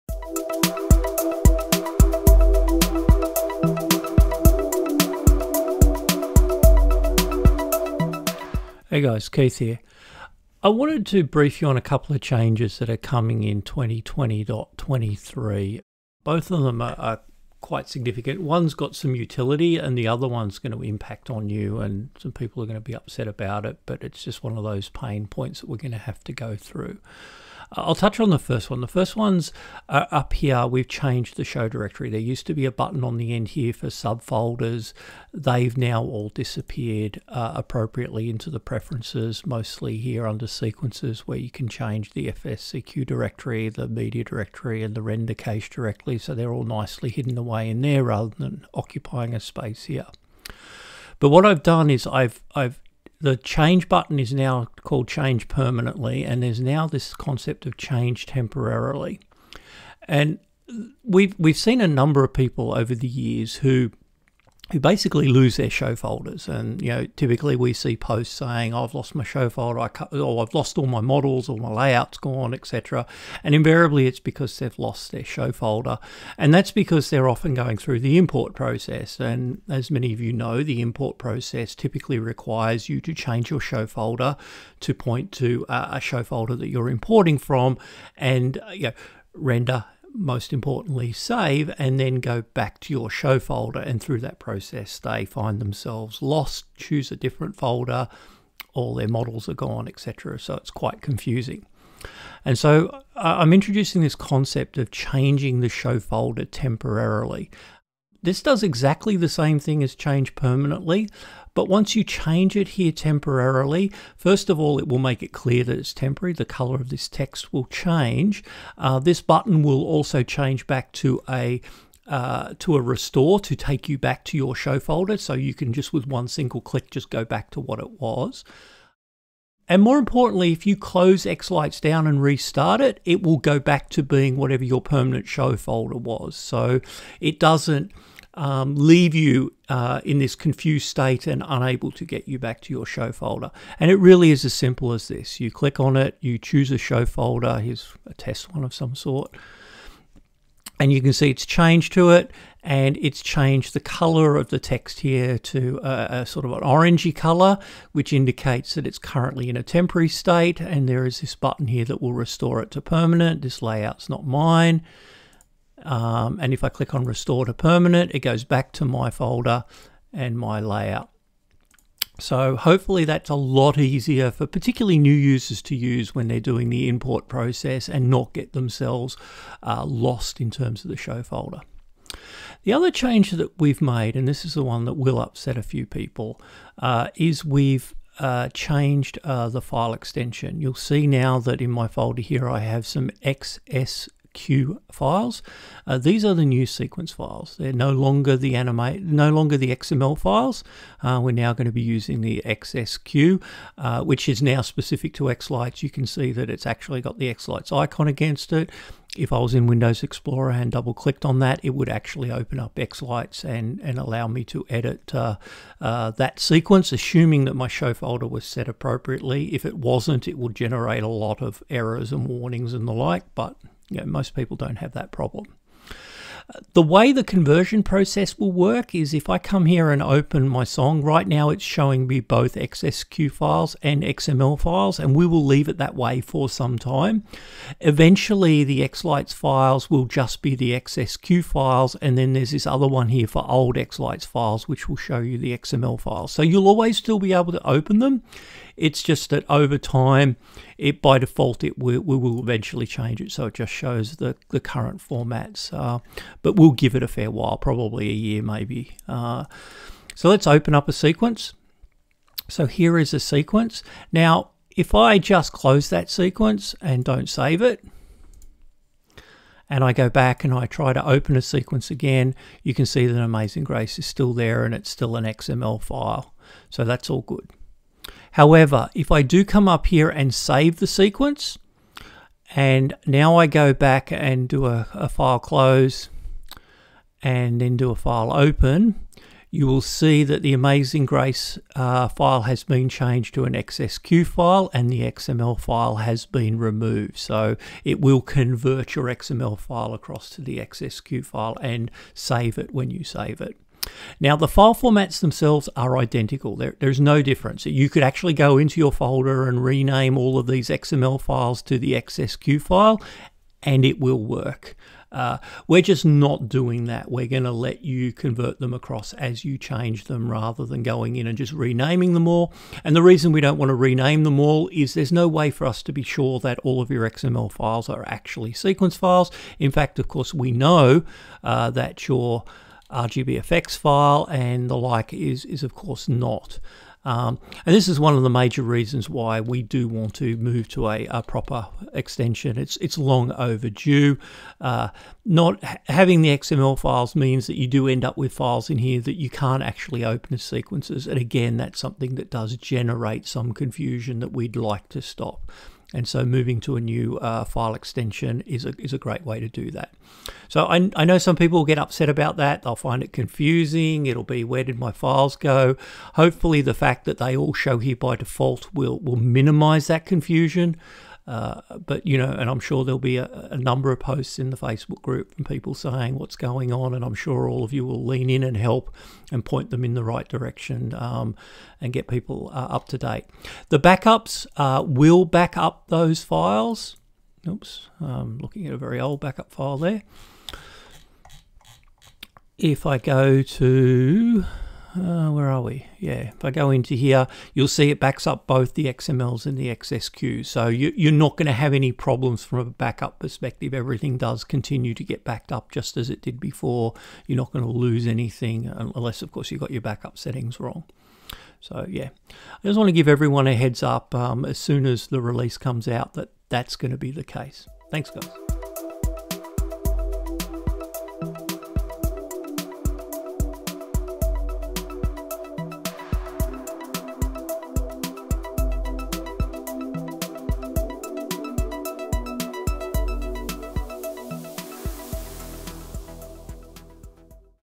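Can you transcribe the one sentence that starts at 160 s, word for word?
And there is this button here that will restore it to permanent.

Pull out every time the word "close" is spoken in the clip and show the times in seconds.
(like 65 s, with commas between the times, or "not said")
130 s, 265 s, 285 s.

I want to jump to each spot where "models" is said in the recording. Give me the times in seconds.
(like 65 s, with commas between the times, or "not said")
71 s, 99 s.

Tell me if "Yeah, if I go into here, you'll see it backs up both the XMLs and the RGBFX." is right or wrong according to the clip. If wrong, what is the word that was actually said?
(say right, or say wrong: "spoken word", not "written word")
wrong: "XSQs", not "RGBFX".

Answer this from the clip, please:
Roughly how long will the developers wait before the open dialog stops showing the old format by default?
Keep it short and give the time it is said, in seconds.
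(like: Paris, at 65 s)
a year, at 258 s.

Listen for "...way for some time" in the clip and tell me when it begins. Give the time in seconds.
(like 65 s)
235 s.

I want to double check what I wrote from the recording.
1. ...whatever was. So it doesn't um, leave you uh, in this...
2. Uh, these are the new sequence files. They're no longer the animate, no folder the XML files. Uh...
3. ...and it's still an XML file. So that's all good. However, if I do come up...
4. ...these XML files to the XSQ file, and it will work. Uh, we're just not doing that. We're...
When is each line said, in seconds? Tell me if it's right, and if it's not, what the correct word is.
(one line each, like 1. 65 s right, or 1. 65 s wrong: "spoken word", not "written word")
1. 135 s wrong: "folder", not "whatever"
2. 195 s wrong: "longer", not "folder"
3. 274 s right
4. 310 s right.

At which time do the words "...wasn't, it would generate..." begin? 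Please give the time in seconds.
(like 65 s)
219 s.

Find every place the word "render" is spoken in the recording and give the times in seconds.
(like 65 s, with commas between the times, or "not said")
45 s, 89 s.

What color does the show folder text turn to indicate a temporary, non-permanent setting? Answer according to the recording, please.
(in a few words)
orangey.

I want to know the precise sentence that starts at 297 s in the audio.
So it will convert your XML file across to the XSQ file and save it when you save it.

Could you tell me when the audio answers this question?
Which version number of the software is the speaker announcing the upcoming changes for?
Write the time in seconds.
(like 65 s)
13 s.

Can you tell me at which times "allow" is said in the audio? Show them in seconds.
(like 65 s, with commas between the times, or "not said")
213 s.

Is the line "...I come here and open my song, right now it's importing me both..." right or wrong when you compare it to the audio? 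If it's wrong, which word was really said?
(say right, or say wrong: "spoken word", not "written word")
wrong: "showing", not "importing".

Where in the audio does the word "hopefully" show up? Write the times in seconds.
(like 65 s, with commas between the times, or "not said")
172 s, 366 s.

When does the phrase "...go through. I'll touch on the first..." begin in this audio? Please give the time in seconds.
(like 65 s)
26 s.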